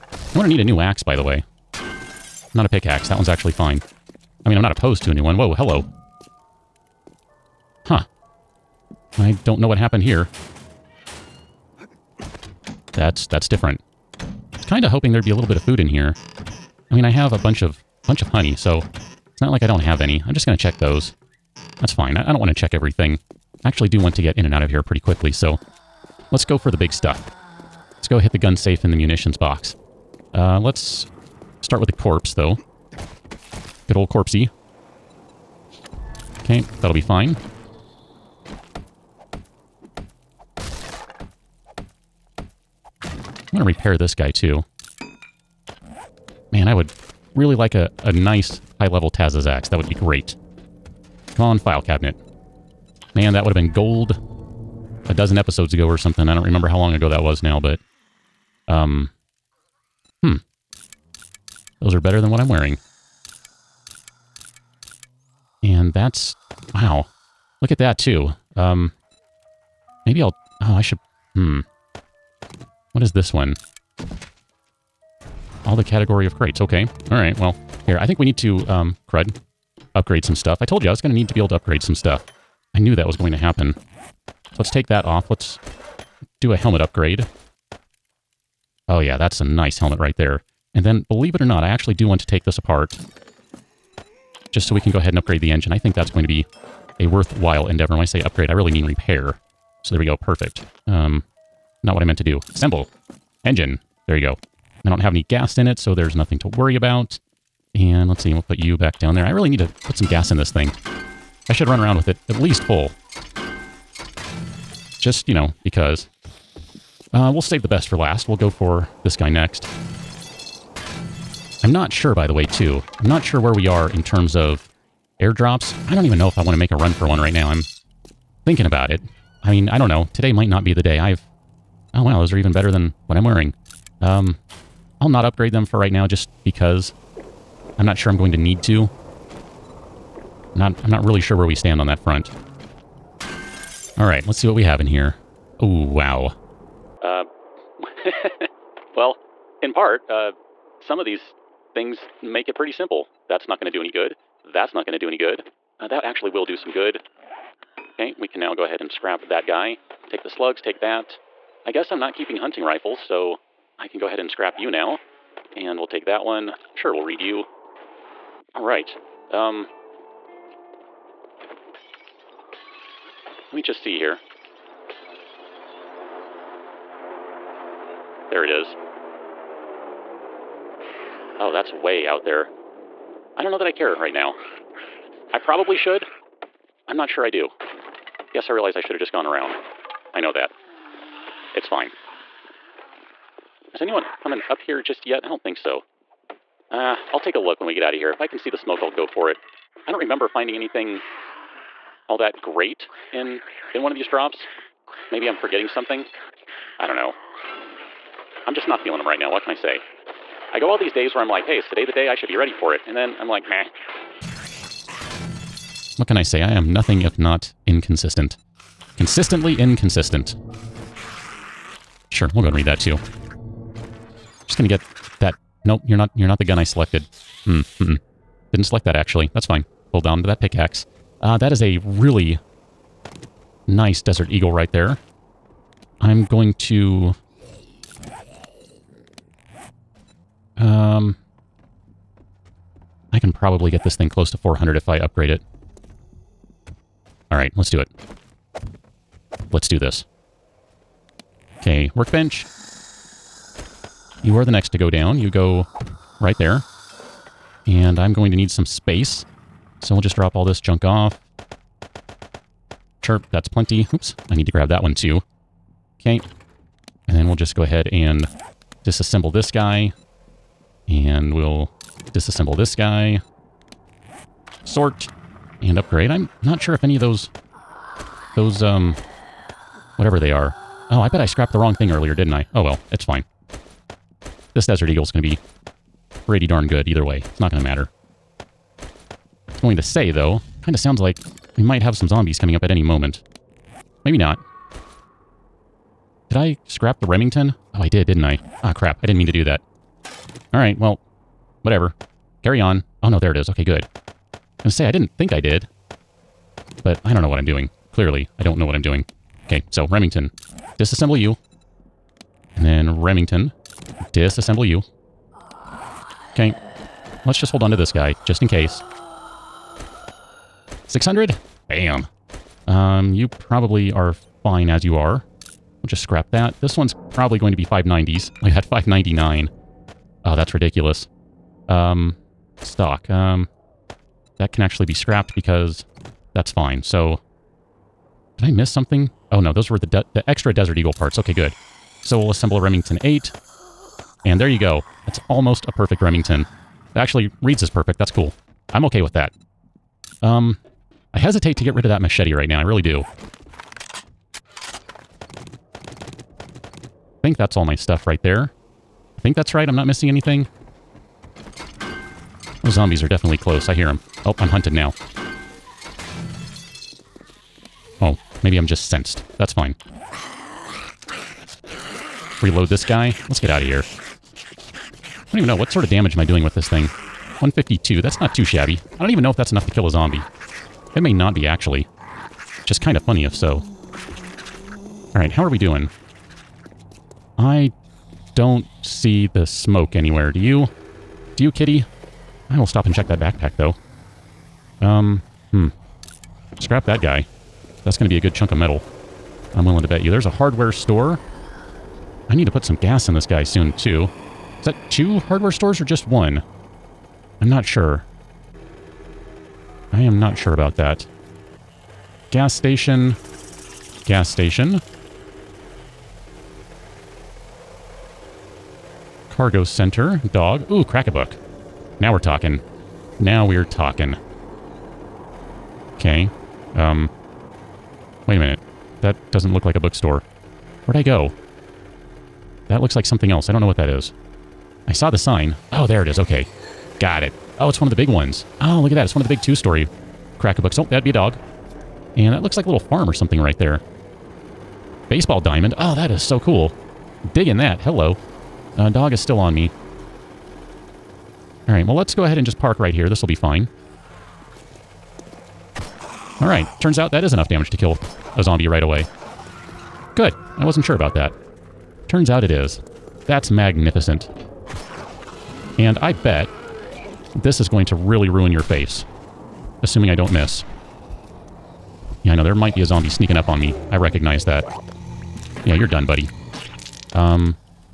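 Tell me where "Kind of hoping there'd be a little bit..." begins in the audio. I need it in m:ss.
0:14.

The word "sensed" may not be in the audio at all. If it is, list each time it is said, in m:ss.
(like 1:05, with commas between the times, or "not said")
6:08.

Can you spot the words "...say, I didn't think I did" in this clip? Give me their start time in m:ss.
5:04.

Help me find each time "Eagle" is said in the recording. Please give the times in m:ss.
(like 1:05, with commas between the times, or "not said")
3:54, 4:44, 5:40.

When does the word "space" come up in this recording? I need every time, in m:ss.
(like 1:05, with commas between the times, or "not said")
4:18.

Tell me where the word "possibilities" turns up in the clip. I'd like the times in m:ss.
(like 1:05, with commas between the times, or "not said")
not said.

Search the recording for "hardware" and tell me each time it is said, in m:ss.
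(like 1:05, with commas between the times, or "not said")
6:40, 6:45.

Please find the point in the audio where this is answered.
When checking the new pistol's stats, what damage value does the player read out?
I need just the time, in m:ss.
6:17.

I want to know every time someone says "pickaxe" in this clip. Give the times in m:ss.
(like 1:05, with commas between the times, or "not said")
0:02, 3:50.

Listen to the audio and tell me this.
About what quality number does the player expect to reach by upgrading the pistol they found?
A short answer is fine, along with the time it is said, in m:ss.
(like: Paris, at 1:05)
400, at 4:04.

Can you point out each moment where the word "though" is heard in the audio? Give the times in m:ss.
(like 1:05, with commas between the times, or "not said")
0:32, 4:50, 6:33.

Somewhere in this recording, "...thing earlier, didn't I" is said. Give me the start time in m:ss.
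4:41.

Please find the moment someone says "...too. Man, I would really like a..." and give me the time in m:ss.
0:44.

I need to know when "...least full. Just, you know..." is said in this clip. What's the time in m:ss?
1:52.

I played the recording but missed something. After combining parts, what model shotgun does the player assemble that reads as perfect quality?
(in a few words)
Remington 8.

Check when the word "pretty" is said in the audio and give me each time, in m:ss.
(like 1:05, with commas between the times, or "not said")
0:24, 2:32, 4:46.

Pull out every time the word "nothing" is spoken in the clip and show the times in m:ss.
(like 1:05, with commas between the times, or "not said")
1:46, 3:36.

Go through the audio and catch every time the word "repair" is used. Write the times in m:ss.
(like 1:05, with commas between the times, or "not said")
0:43, 1:38.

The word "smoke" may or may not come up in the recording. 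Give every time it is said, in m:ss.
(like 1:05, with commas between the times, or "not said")
3:18, 6:29.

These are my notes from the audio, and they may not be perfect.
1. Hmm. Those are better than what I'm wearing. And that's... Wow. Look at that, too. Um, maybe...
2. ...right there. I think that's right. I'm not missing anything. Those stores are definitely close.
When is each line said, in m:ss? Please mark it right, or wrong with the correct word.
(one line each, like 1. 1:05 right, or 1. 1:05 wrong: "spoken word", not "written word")
1. 1:00 right
2. 5:58 wrong: "zombies", not "stores".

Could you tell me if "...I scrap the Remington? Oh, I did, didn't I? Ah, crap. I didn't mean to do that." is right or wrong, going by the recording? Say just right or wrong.
right.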